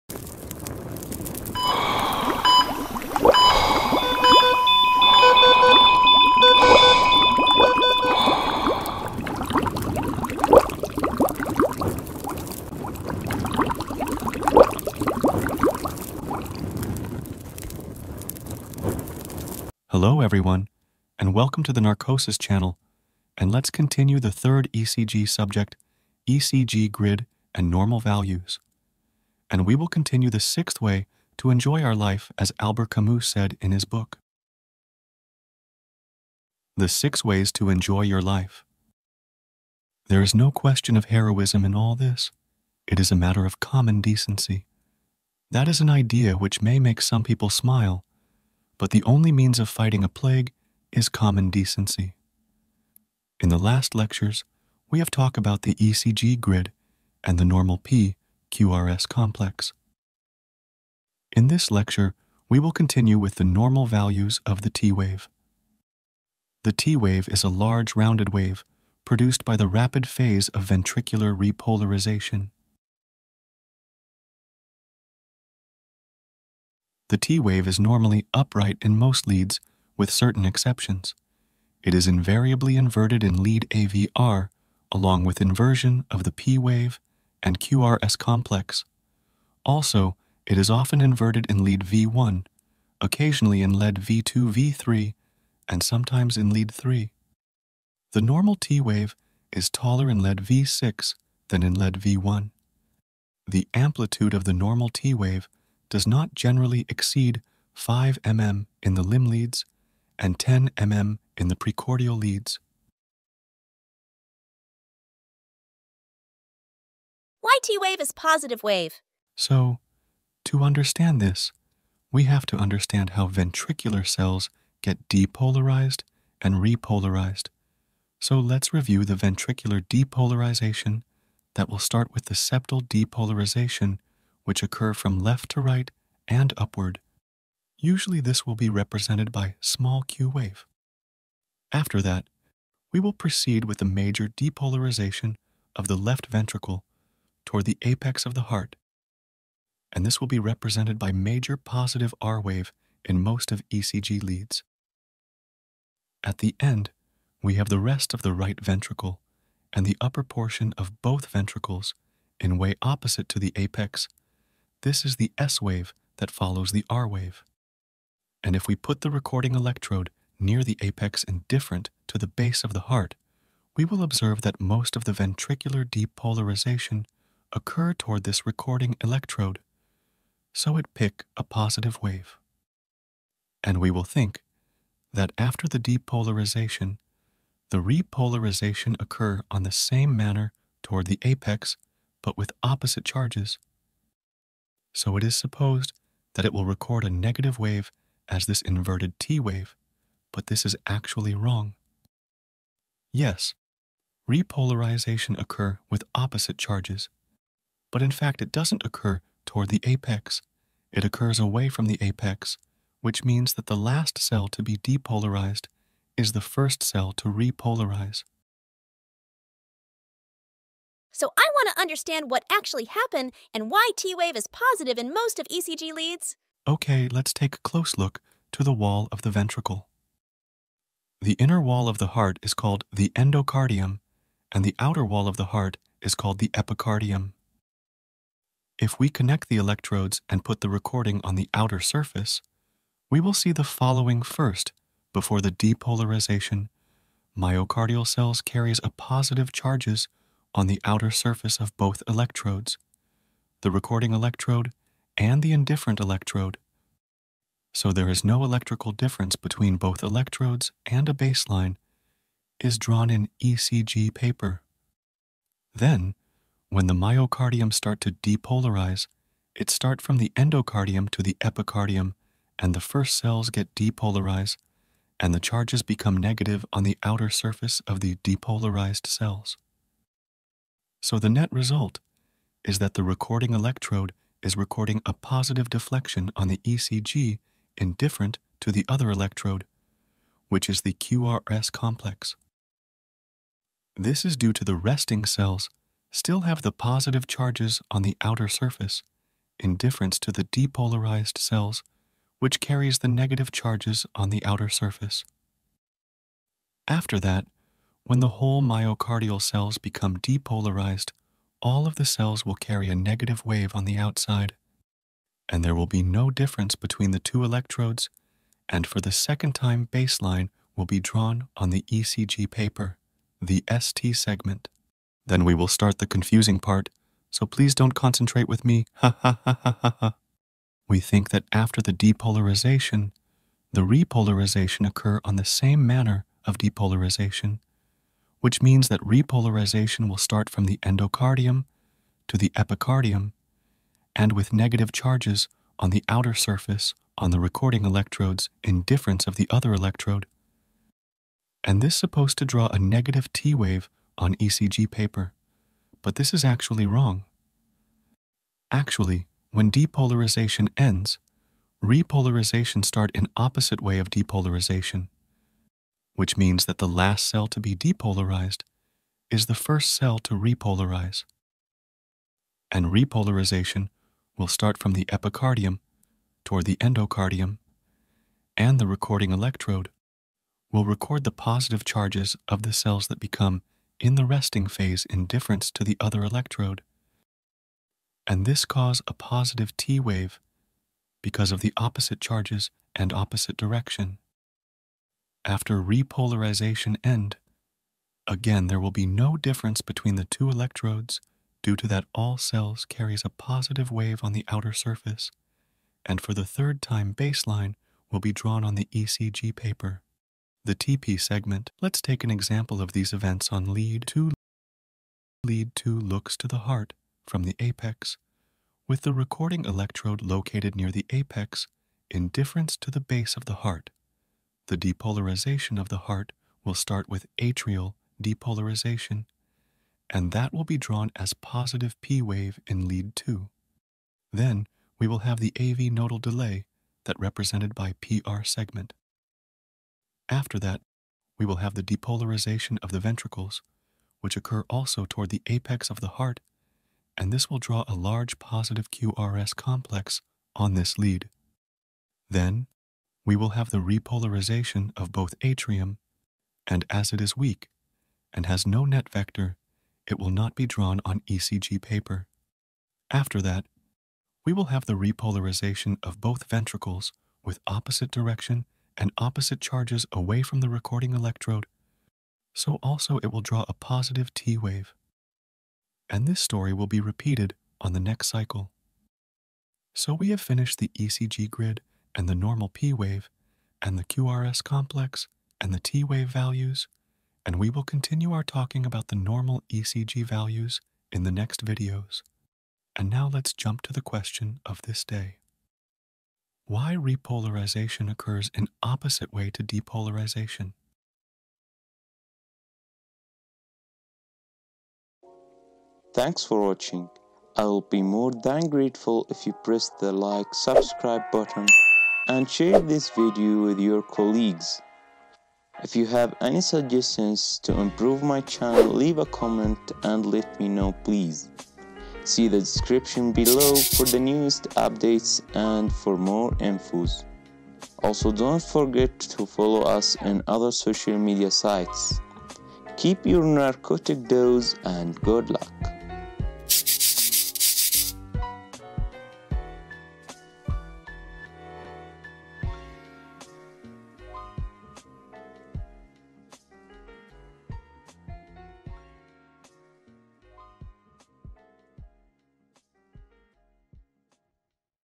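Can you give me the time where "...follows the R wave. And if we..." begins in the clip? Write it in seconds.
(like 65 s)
166 s.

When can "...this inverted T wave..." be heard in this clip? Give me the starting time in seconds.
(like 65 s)
198 s.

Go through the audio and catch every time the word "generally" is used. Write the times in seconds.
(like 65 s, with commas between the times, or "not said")
106 s.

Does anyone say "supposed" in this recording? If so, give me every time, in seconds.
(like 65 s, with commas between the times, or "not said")
195 s, 351 s.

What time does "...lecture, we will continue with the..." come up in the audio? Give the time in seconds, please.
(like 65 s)
61 s.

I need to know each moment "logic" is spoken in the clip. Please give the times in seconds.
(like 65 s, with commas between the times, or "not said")
not said.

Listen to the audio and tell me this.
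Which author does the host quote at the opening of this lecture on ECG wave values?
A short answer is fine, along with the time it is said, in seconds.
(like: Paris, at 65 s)
Albert Camus, at 32 s.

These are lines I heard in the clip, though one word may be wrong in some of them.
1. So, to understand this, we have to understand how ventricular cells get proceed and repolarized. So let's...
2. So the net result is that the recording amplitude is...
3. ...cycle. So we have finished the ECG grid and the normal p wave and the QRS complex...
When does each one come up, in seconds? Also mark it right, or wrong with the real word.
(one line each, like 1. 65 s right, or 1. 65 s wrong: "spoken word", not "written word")
1. 119 s wrong: "depolarized", not "proceed"
2. 281 s wrong: "electrode", not "amplitude"
3. 478 s right.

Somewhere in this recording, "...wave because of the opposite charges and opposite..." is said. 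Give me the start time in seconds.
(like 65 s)
389 s.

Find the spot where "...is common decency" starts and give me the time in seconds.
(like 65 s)
50 s.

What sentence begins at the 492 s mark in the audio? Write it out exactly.
And now let's jump to the question of this day.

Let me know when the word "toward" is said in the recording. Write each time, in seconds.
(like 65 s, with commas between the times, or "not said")
147 s, 177 s, 190 s, 209 s, 376 s, 445 s.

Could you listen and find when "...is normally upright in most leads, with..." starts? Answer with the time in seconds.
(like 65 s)
77 s.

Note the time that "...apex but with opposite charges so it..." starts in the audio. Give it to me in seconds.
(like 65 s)
191 s.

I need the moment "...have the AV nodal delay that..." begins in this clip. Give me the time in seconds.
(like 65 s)
435 s.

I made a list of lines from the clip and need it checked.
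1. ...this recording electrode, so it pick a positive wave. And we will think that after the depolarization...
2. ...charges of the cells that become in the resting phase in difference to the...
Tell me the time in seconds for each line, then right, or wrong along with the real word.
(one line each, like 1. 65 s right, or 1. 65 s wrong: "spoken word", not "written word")
1. 178 s right
2. 381 s right.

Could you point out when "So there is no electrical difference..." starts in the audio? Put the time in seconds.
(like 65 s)
257 s.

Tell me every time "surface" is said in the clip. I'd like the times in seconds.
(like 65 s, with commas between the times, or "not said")
241 s, 251 s, 277 s, 298 s, 304 s, 346 s, 404 s.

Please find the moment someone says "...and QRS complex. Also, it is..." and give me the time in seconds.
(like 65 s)
87 s.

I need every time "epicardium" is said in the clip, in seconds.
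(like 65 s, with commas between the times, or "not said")
236 s, 271 s, 342 s, 375 s.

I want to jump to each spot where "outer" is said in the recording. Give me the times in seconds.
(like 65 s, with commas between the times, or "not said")
234 s, 241 s, 250 s, 277 s, 298 s, 304 s, 346 s, 404 s.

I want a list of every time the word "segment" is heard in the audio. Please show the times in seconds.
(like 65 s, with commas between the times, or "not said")
324 s, 411 s, 438 s.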